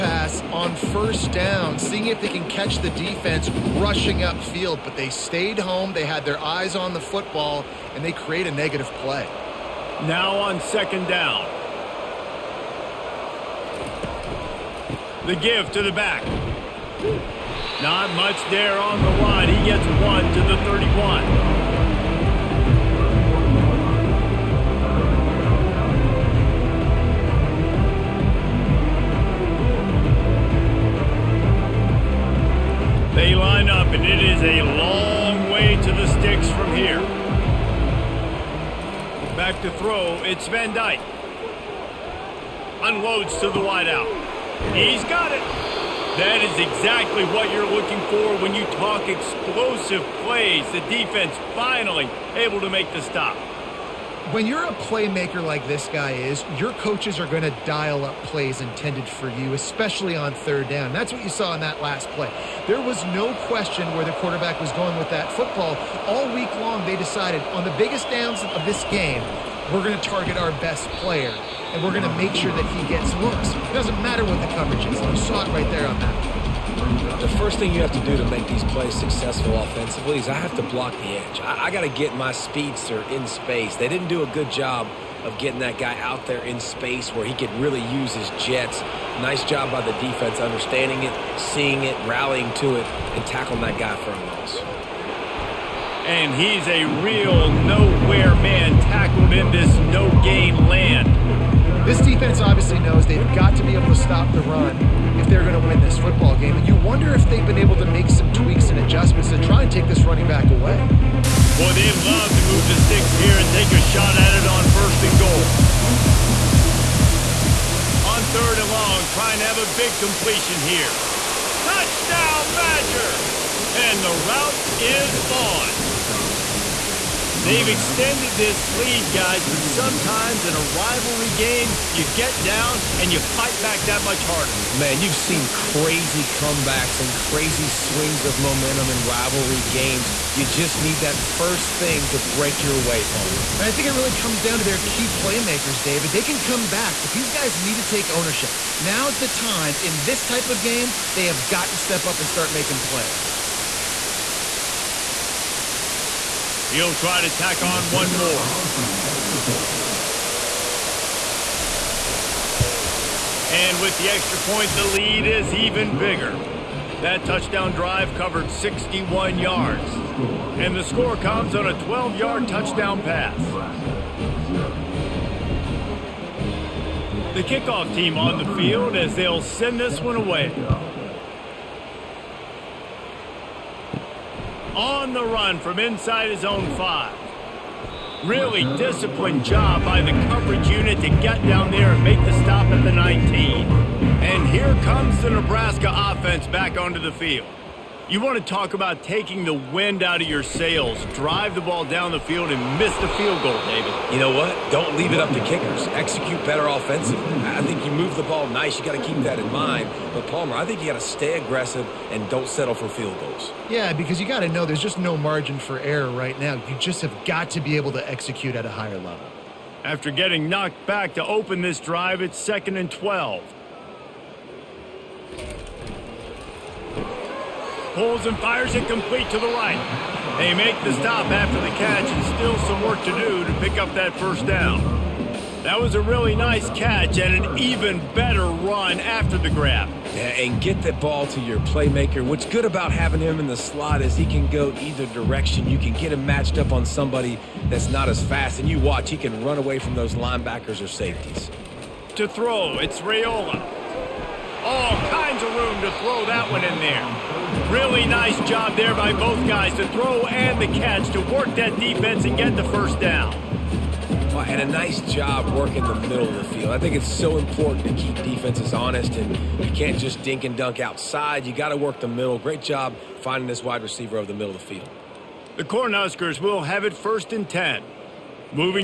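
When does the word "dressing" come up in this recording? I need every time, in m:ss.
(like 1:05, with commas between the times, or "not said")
not said.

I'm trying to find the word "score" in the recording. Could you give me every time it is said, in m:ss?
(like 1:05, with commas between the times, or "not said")
2:50.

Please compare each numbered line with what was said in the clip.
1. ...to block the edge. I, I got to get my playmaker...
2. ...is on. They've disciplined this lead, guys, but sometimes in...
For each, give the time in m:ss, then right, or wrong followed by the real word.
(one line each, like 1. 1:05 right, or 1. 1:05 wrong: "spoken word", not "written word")
1. 1:20 wrong: "speedster", not "playmaker"
2. 2:04 wrong: "extended", not "disciplined".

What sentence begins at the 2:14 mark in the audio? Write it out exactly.
Man, you've seen crazy comebacks and crazy swings of momentum in rivalry games.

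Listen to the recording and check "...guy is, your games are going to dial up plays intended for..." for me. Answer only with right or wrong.
wrong.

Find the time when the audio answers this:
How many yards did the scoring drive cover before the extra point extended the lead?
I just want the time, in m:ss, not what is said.
2:48.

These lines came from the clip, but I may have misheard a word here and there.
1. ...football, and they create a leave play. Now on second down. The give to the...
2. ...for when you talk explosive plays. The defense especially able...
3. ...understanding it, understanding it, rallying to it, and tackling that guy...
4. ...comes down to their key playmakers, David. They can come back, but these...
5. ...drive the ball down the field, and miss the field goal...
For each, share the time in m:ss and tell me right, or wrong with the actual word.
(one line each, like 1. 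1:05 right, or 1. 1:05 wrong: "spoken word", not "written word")
1. 0:06 wrong: "negative", not "leave"
2. 0:48 wrong: "finally", not "especially"
3. 1:30 wrong: "seeing", not "understanding"
4. 2:24 right
5. 3:21 right.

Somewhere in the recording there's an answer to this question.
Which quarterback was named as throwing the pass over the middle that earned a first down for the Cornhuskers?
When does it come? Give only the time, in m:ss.
4:12.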